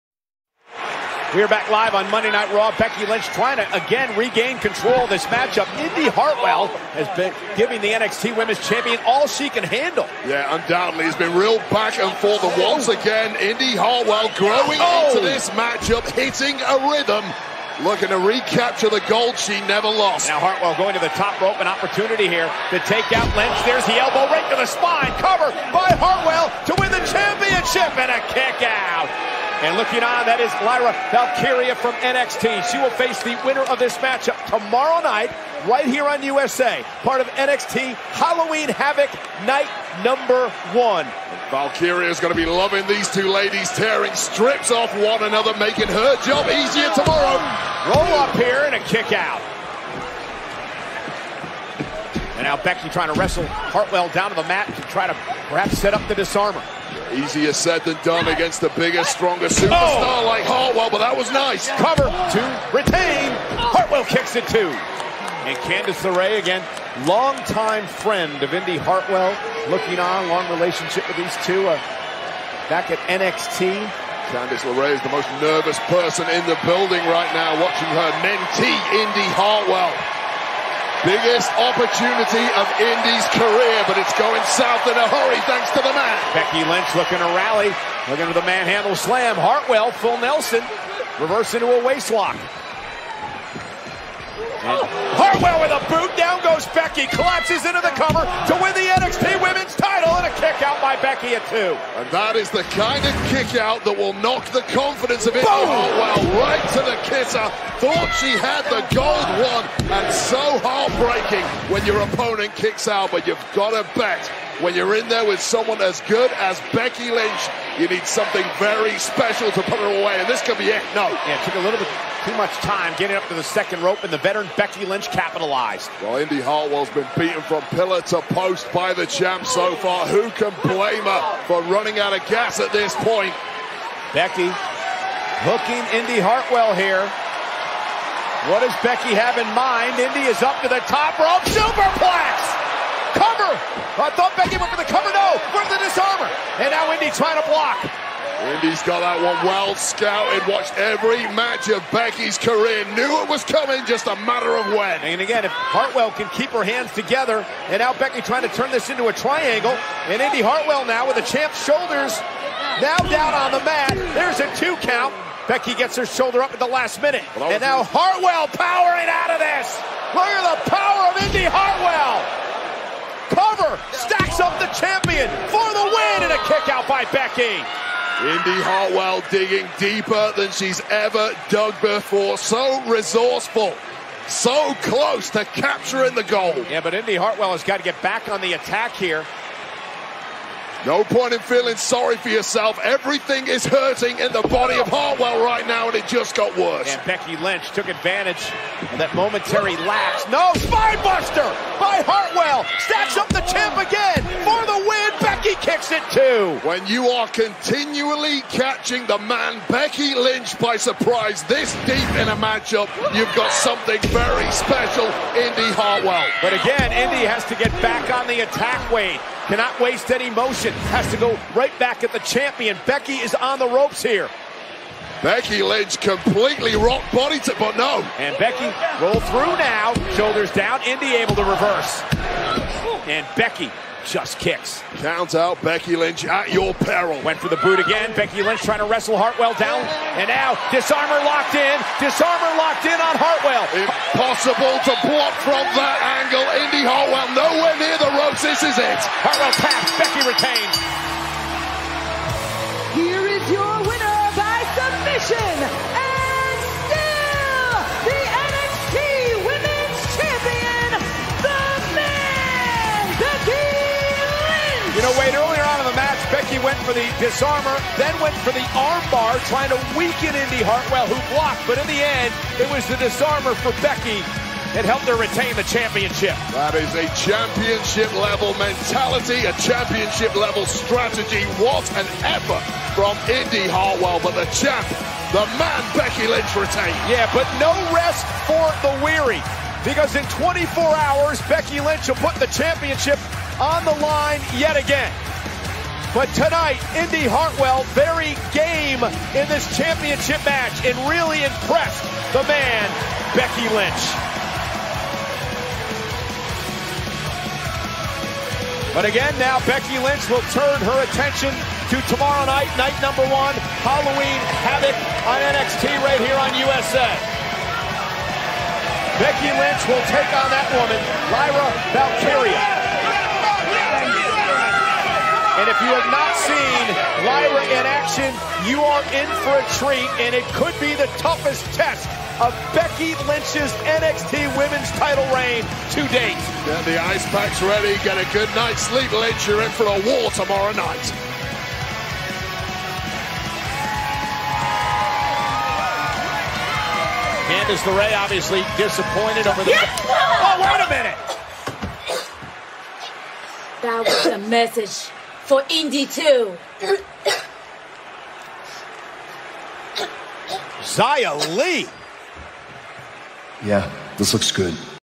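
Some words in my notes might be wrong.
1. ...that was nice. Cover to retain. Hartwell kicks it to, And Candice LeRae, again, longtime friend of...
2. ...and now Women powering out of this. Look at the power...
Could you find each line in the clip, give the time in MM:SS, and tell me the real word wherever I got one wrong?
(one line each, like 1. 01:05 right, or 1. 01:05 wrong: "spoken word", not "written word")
1. 01:00 right
2. 02:47 wrong: "Hartwell", not "Women".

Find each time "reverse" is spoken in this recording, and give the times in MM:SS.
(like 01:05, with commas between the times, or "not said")
01:31, 03:51.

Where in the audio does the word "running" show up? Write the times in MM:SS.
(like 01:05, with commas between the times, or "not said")
02:11.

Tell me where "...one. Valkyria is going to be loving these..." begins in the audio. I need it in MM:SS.
00:40.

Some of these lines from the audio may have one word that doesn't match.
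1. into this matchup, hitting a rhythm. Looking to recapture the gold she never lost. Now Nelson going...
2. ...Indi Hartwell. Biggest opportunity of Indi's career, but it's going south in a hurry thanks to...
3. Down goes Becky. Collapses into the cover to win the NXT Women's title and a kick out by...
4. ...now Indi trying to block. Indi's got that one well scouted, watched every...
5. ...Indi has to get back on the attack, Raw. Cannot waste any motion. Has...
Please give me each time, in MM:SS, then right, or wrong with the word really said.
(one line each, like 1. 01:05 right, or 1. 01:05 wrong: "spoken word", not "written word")
1. 00:15 wrong: "Hartwell", not "Nelson"
2. 01:18 right
3. 01:36 right
4. 02:26 right
5. 03:36 wrong: "Wade", not "Raw".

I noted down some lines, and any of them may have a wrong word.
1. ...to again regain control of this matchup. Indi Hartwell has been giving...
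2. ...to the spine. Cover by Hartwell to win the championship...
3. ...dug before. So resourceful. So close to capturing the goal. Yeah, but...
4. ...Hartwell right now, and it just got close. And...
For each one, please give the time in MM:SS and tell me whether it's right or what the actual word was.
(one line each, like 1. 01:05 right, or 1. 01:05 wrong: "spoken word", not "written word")
1. 00:03 right
2. 00:24 right
3. 03:01 right
4. 03:14 wrong: "worse", not "close".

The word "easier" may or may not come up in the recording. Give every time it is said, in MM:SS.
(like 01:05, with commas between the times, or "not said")
00:46, 00:57.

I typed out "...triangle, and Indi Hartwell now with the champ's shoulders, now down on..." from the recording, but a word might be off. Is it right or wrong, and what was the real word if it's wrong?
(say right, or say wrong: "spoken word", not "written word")
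right.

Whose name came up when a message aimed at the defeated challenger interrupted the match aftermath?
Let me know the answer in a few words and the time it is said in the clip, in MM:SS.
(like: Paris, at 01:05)
Xia Li, at 06:00.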